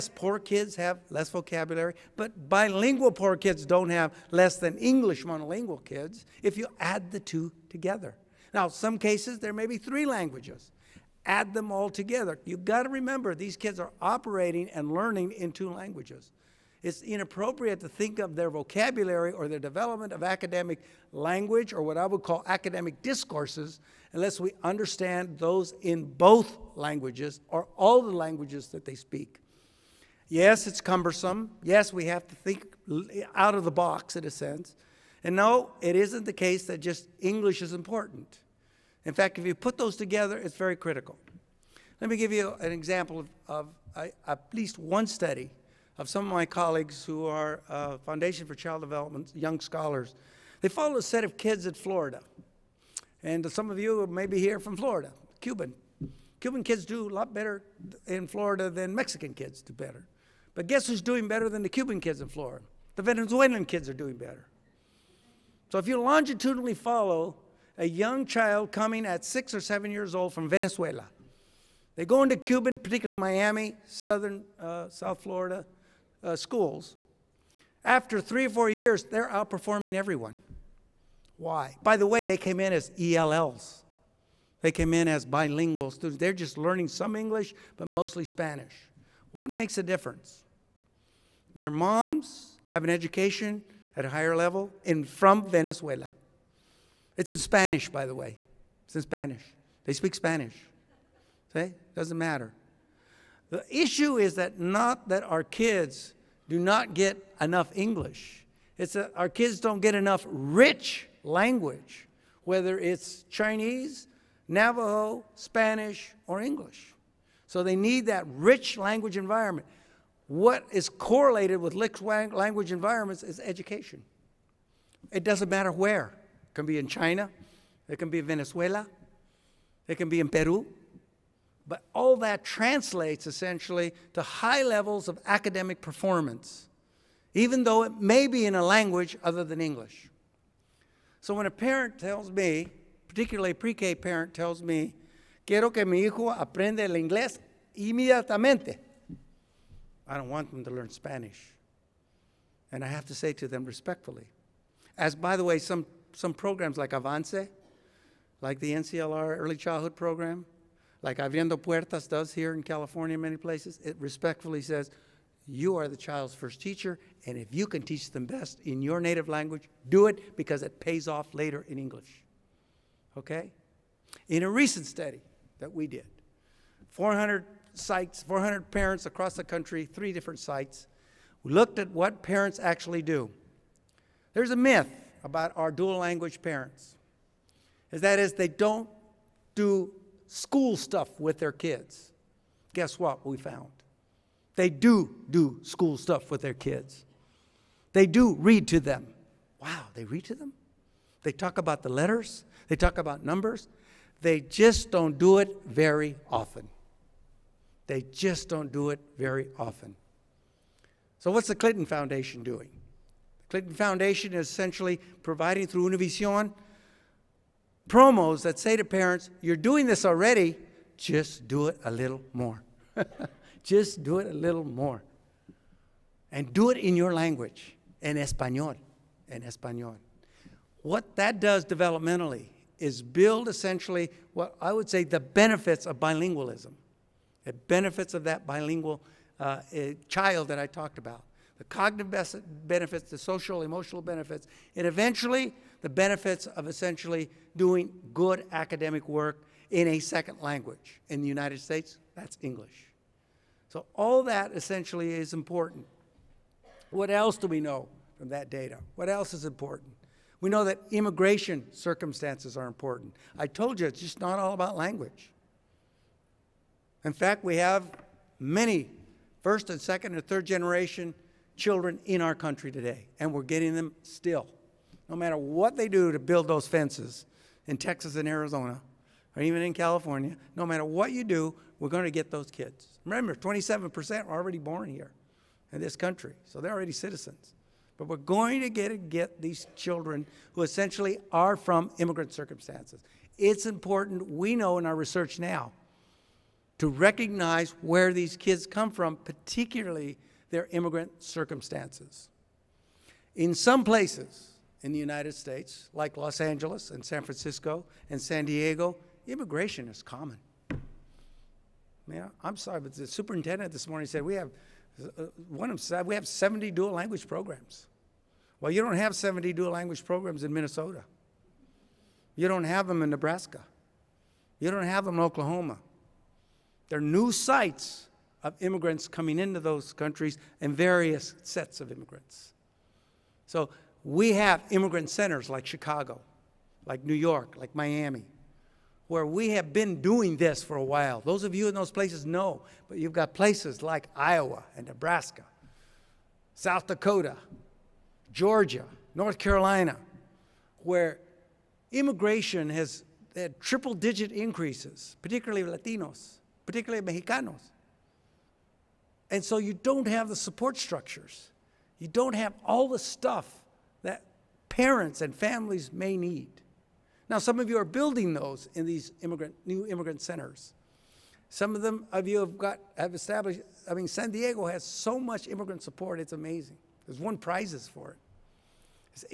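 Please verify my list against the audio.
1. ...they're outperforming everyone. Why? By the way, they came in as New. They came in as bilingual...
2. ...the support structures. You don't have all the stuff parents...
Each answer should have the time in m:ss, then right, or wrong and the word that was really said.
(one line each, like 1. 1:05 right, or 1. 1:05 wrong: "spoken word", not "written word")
1. 1:19 wrong: "ELLs", not "New"
2. 6:00 right.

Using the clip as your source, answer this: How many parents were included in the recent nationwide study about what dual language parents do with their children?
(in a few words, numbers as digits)
400.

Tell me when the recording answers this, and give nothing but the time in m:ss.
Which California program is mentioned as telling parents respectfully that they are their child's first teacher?
2:41.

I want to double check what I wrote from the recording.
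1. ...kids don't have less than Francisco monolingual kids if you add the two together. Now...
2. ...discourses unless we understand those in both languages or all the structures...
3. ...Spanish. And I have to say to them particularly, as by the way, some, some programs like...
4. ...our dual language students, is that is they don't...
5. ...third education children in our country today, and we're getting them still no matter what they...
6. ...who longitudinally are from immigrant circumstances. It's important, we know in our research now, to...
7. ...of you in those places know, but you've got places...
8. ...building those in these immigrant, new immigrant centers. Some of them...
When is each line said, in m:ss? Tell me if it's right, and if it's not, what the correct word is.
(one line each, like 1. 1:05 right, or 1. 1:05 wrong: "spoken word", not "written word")
1. 0:03 wrong: "English", not "Francisco"
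2. 0:23 wrong: "languages", not "structures"
3. 2:30 wrong: "respectfully", not "particularly"
4. 3:05 wrong: "parents", not "students"
5. 4:30 wrong: "generation", not "education"
6. 4:50 wrong: "essentially", not "longitudinally"
7. 5:41 right
8. 6:07 right.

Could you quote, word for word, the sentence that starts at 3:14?
They do do school stuff with their kids.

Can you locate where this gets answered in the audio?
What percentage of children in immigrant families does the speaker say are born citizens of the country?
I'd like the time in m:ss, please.
4:43.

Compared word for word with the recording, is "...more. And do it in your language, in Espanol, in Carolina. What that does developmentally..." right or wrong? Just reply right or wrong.
wrong.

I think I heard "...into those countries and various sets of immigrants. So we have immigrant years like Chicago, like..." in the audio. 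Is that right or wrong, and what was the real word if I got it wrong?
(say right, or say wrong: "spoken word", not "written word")
wrong: "centers", not "years".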